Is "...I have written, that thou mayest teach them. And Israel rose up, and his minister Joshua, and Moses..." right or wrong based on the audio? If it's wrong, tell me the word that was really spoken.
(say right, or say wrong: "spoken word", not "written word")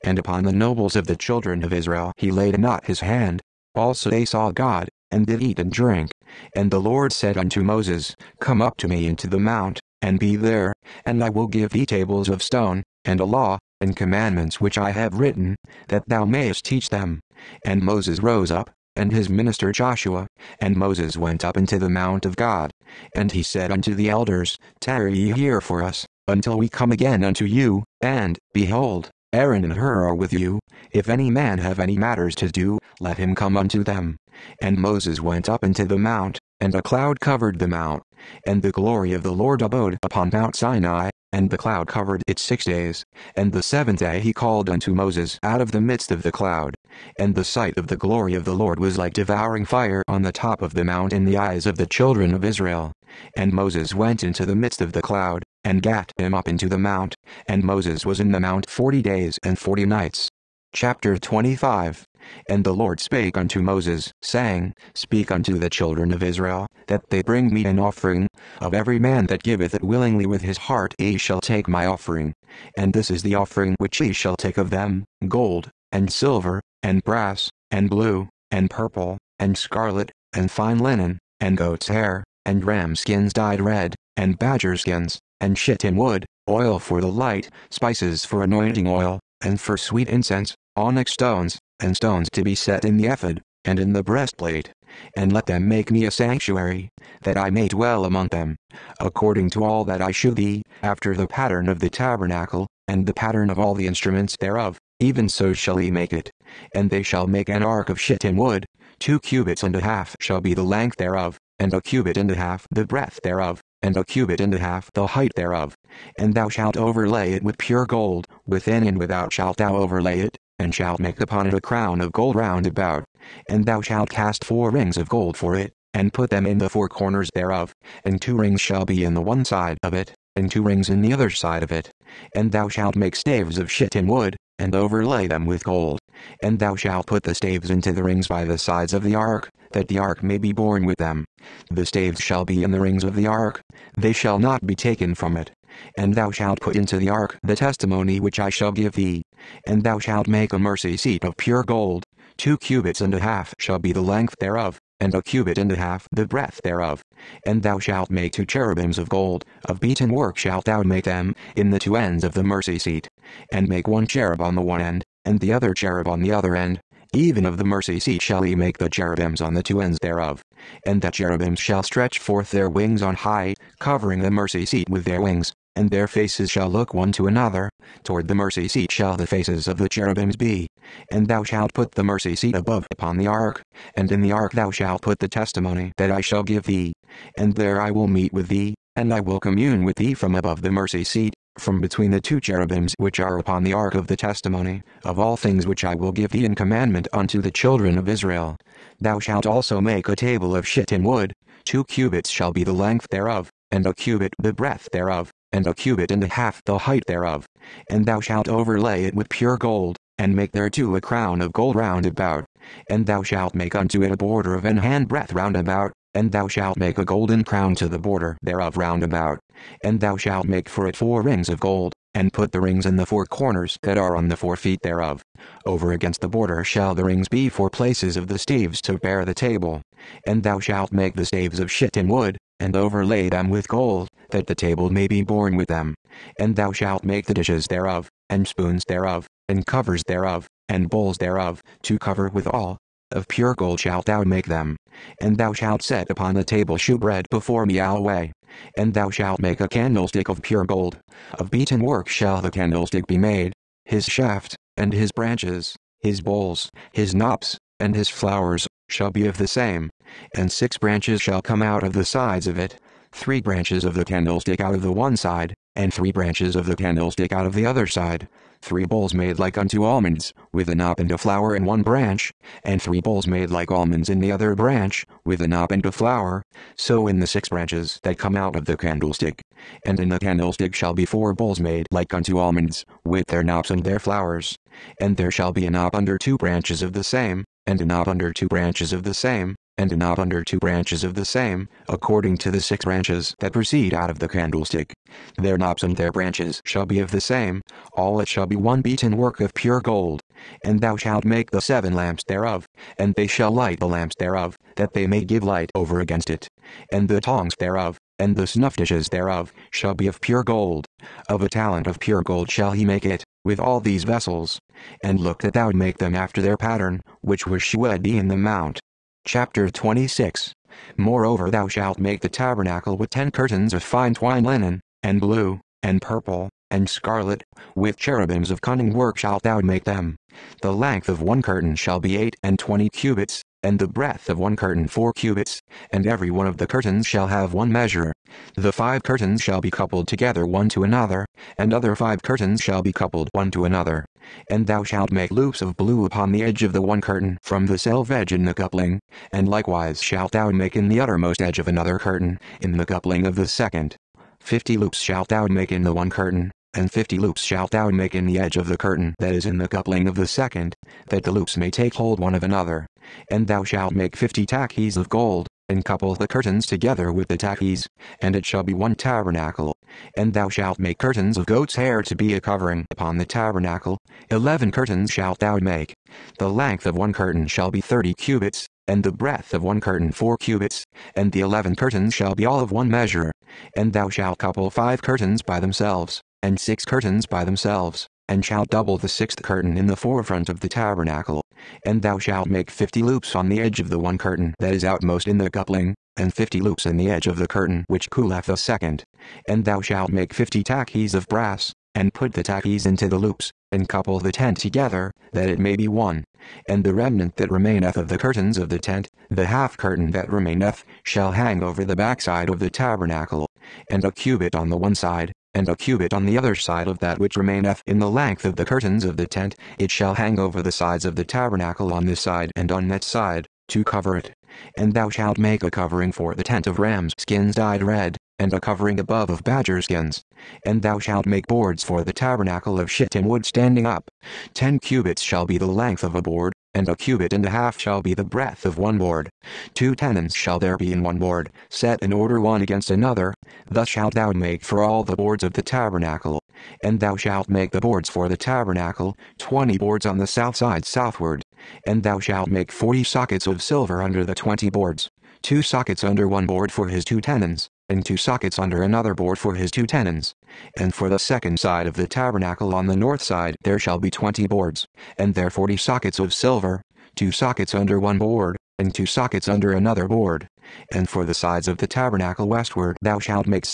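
wrong: "Moses", not "Israel".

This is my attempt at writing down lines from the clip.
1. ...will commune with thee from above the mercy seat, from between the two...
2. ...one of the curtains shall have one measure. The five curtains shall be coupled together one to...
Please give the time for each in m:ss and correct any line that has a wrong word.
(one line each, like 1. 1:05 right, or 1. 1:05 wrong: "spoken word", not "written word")
1. 3:09 right
2. 5:36 right.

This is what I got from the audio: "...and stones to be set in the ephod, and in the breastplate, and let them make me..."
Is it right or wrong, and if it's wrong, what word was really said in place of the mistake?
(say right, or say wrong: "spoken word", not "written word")
right.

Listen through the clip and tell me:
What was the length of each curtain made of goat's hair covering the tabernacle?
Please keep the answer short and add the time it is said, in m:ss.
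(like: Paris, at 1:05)
30 cubits, at 6:17.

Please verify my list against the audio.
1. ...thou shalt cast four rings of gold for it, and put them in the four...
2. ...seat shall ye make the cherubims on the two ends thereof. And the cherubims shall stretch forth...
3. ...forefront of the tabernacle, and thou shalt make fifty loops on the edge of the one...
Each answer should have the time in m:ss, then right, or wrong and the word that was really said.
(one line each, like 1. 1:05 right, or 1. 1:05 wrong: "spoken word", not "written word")
1. 2:03 right
2. 2:47 right
3. 6:29 right.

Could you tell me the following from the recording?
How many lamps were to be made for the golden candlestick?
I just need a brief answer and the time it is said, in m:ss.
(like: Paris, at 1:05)
7, at 5:01.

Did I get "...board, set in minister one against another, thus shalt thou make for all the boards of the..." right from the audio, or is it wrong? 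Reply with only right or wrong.
wrong.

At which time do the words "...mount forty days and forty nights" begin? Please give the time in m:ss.
0:58.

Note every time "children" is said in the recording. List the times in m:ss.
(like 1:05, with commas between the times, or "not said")
0:01, 0:51, 1:05, 3:17.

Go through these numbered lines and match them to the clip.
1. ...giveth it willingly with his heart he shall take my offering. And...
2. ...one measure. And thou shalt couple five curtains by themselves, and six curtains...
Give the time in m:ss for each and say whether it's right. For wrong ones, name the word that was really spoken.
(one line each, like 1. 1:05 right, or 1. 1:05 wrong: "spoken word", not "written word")
1. 1:09 right
2. 6:22 right.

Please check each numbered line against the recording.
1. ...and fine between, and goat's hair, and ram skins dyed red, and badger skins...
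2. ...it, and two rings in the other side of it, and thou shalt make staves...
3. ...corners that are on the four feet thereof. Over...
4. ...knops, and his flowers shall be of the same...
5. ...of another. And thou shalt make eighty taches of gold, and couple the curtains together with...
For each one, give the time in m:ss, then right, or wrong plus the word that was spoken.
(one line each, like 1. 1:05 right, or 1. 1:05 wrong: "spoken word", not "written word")
1. 1:20 wrong: "linen", not "between"
2. 2:09 right
3. 3:43 right
4. 4:17 right
5. 6:02 wrong: "fifty", not "eighty".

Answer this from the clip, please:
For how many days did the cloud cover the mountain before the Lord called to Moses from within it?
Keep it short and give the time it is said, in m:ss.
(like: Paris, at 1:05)
6, at 0:42.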